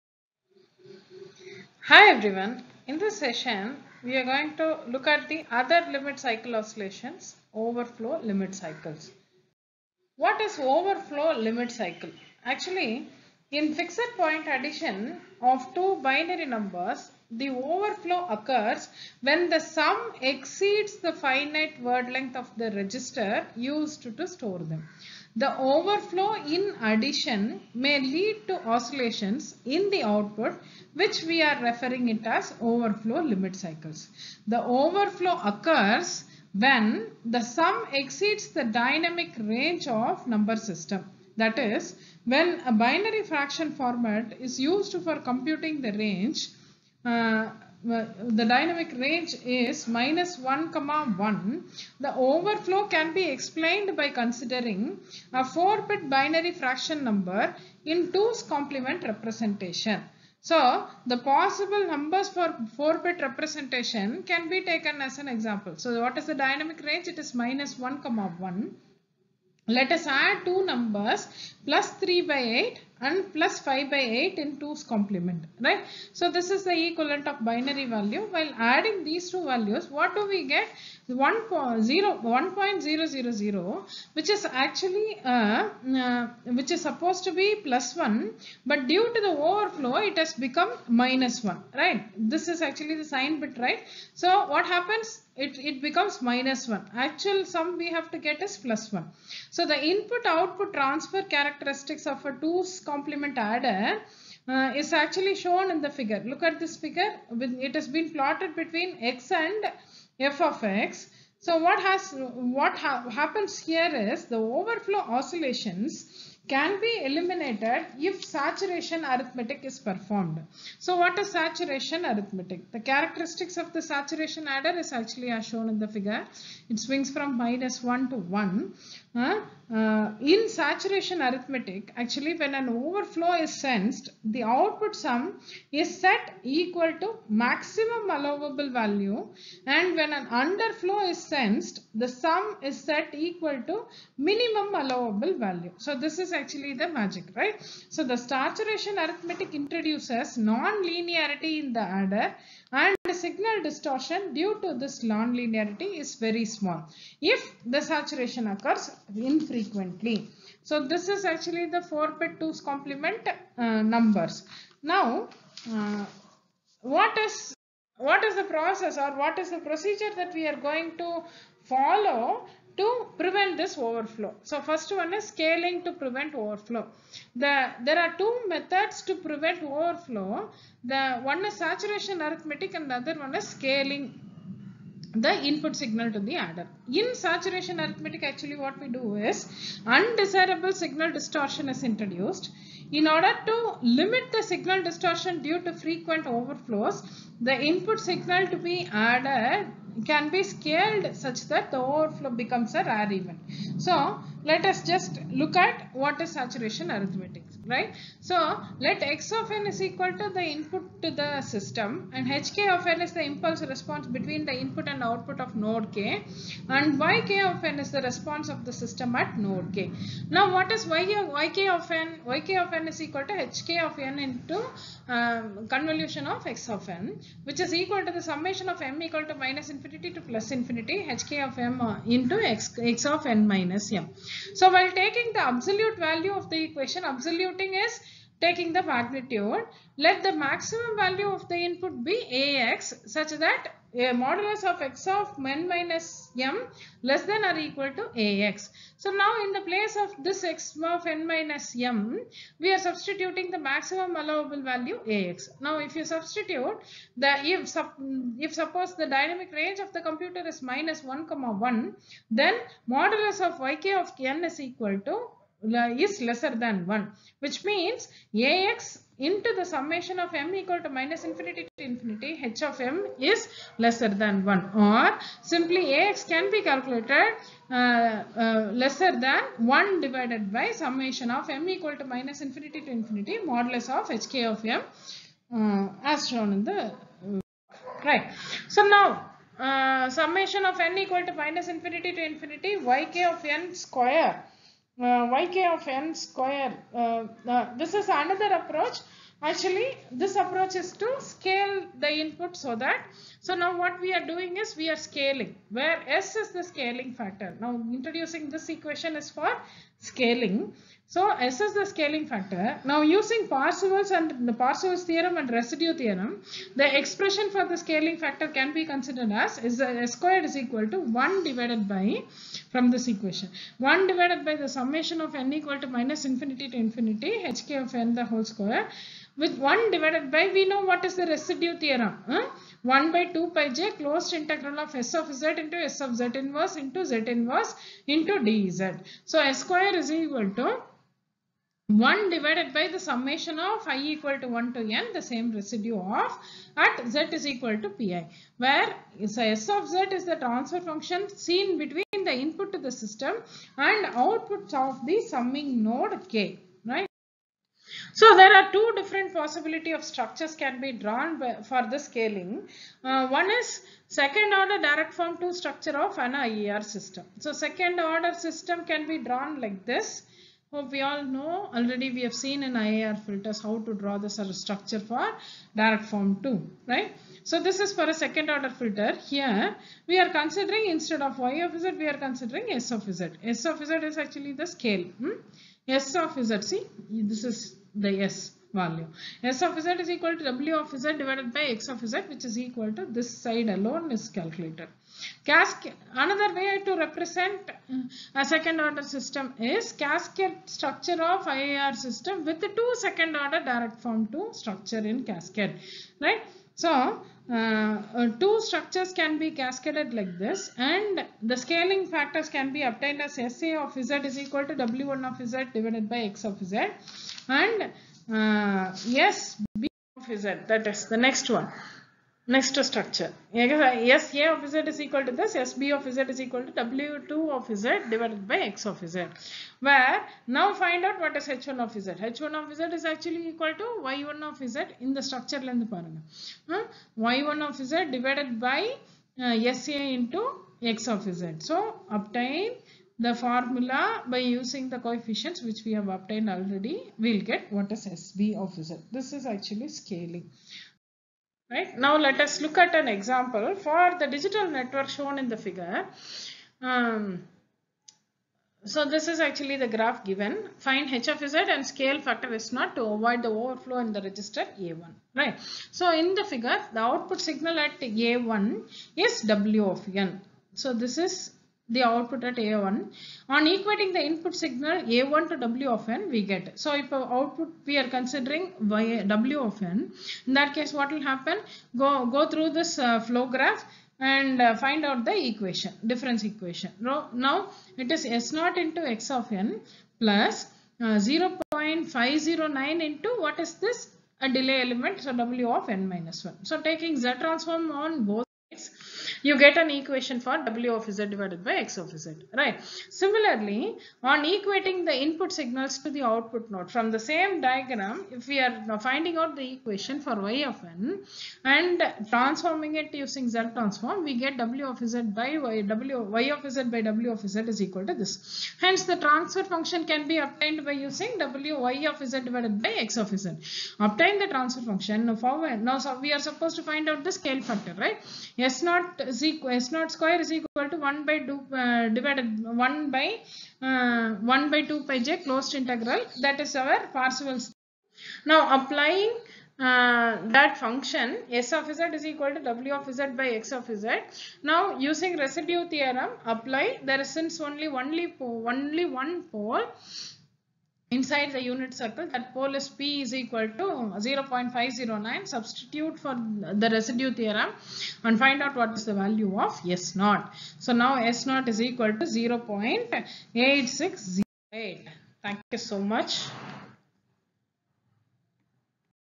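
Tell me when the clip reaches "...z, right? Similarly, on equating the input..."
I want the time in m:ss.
8:22.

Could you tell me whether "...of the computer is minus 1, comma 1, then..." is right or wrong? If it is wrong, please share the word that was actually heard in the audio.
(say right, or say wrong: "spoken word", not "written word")
right.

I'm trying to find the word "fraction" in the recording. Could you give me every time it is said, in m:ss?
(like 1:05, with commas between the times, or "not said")
0:43, 0:56.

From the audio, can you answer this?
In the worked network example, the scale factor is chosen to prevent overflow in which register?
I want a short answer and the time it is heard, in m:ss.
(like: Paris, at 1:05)
A1, at 7:44.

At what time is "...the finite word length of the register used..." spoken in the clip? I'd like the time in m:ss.
0:20.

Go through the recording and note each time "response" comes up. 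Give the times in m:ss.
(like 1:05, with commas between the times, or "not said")
3:33, 3:38.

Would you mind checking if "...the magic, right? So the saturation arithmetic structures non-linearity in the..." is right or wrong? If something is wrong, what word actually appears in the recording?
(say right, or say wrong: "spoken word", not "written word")
wrong: "introduces", not "structures".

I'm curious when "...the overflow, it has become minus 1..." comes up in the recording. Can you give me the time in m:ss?
1:29.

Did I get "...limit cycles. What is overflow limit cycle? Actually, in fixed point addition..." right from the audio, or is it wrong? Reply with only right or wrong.
right.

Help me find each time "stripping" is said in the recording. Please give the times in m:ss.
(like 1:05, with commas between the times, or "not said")
not said.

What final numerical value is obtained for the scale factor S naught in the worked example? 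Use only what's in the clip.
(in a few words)
0.8608.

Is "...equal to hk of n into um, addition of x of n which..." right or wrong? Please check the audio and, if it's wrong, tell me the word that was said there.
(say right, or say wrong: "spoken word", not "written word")
wrong: "convolution", not "addition".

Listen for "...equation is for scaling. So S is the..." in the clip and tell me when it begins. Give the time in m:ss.
5:08.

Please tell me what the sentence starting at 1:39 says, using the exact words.
So the input-output transfer characteristics of a 2's complement adder uh, is actually shown in the figure.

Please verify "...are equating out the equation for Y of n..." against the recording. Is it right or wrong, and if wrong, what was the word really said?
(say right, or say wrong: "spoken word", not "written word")
wrong: "finding", not "equating".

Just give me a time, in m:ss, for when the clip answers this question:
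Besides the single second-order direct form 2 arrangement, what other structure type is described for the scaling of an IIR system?
6:39.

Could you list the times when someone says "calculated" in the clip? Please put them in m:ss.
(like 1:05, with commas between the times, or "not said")
4:36, 6:34.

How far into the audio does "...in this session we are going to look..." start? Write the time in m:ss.
0:02.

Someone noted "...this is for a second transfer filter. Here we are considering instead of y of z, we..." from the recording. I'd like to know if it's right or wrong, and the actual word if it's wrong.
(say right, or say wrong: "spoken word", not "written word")
wrong: "order", not "transfer".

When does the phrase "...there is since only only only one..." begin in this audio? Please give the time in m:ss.
9:07.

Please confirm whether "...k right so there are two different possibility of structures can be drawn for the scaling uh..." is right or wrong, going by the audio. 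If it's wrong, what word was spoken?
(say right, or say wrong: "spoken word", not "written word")
right.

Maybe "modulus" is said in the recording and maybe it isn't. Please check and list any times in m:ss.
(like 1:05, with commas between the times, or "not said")
4:04, 4:22, 4:43.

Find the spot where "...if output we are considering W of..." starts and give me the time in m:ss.
7:56.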